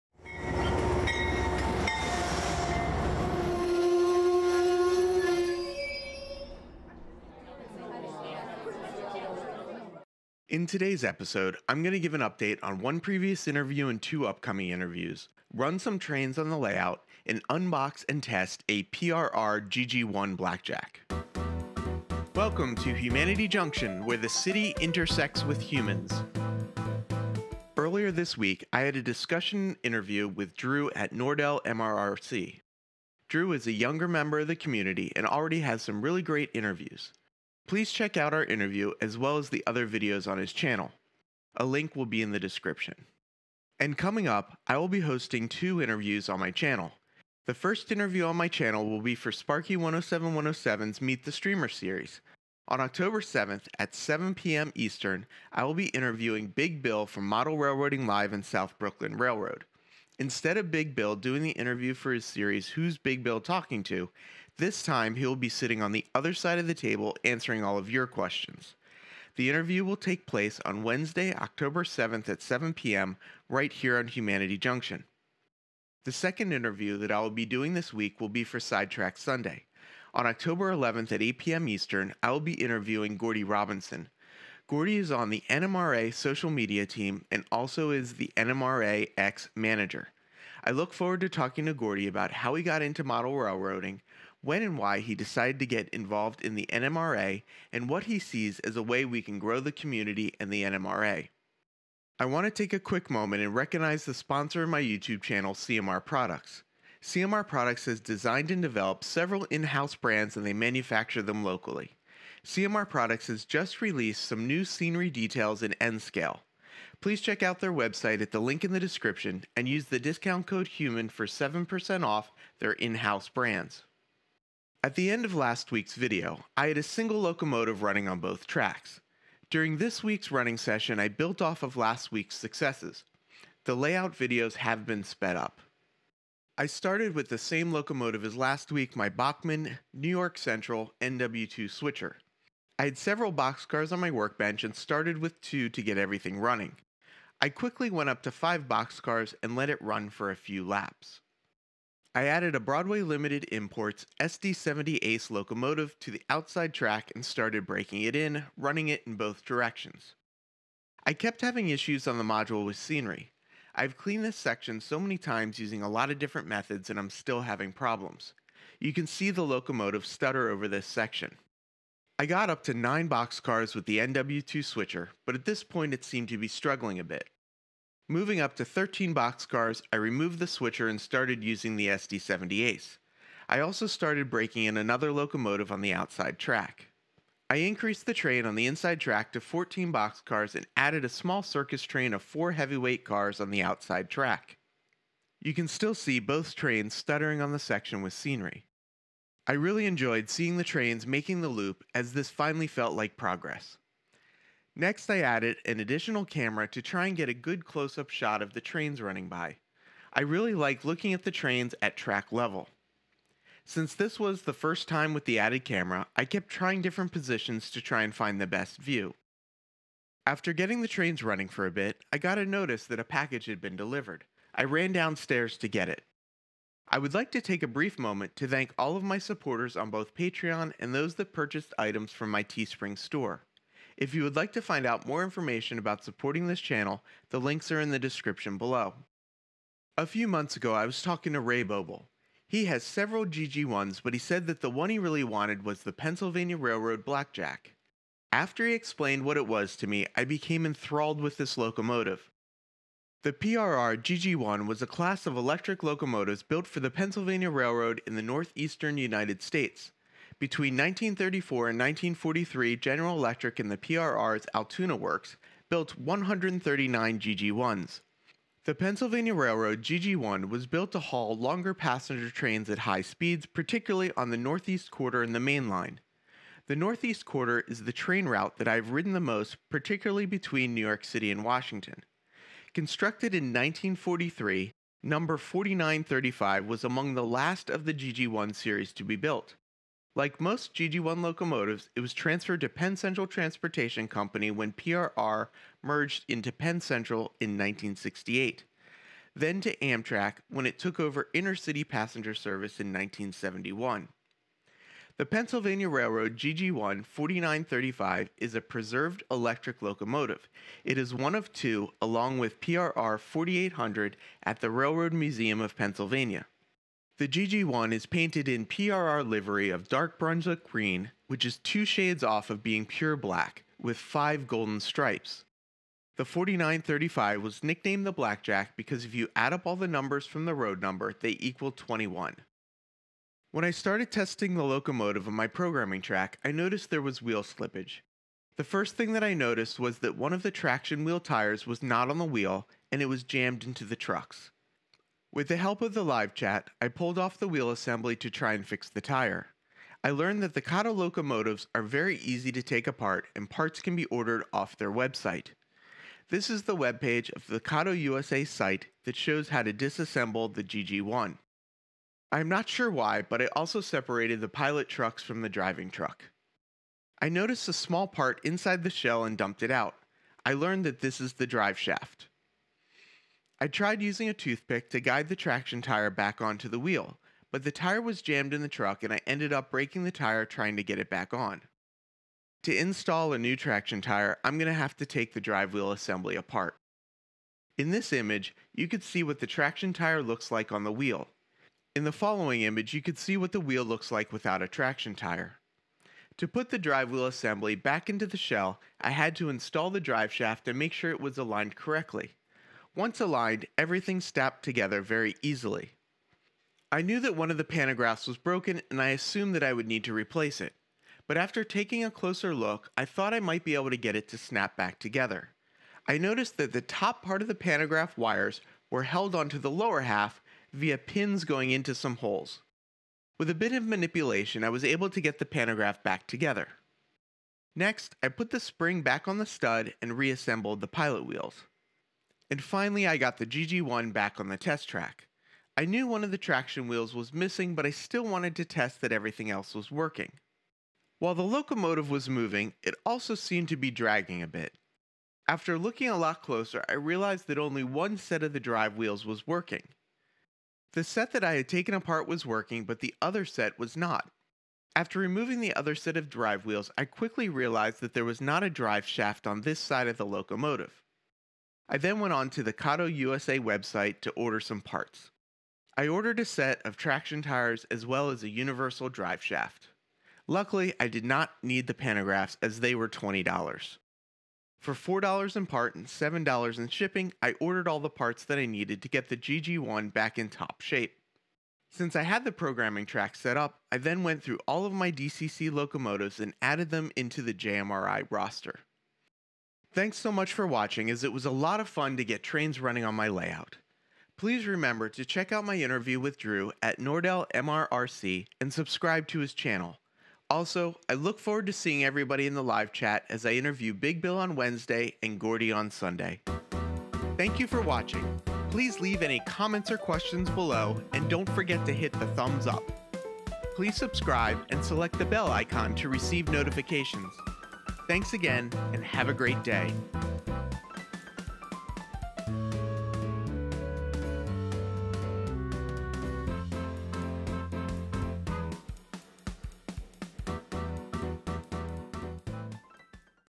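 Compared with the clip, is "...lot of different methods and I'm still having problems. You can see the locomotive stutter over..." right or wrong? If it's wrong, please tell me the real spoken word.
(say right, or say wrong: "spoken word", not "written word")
right.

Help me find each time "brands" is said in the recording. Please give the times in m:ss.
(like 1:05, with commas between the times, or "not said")
1:49, 2:03.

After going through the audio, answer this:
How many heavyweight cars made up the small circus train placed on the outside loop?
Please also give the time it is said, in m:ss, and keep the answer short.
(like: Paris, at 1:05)
4, at 3:12.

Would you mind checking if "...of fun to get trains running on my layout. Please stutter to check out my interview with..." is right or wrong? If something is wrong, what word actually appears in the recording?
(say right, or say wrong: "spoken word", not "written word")
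wrong: "remember", not "stutter".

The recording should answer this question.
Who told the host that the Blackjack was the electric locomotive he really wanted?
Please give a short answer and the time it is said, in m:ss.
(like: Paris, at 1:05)
Ray Bobel, at 4:01.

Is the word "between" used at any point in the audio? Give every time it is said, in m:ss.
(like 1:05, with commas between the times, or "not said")
4:20, 4:40.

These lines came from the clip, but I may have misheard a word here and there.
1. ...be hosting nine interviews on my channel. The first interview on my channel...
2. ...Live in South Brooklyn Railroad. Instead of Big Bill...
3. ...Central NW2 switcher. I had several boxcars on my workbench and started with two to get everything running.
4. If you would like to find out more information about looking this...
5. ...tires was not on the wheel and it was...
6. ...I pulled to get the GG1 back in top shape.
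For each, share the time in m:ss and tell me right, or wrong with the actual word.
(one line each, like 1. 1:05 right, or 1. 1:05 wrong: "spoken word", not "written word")
1. 0:44 wrong: "two", not "nine"
2. 0:58 right
3. 2:20 right
4. 3:54 wrong: "supporting", not "looking"
5. 5:41 right
6. 7:58 wrong: "needed", not "pulled".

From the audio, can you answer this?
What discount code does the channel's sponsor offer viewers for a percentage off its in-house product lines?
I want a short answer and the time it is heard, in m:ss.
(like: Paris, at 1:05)
HUMAN, at 2:00.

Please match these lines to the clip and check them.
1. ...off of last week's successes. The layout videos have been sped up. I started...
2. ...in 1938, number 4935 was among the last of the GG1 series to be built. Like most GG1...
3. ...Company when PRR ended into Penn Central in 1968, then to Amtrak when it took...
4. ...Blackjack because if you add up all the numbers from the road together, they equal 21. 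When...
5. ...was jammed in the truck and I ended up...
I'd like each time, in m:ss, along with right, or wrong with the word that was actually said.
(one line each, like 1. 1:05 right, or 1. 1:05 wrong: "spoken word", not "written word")
1. 2:11 right
2. 4:43 wrong: "1943", not "1938"
3. 4:54 wrong: "merged", not "ended"
4. 5:28 wrong: "number", not "together"
5. 6:18 right.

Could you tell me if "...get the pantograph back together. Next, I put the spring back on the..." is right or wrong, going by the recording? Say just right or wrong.
right.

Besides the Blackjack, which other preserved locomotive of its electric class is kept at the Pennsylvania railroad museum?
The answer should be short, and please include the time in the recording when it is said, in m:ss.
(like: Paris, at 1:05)
PRR 4800, at 5:12.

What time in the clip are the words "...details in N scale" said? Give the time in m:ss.
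1:55.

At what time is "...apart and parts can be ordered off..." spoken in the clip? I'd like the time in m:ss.
5:52.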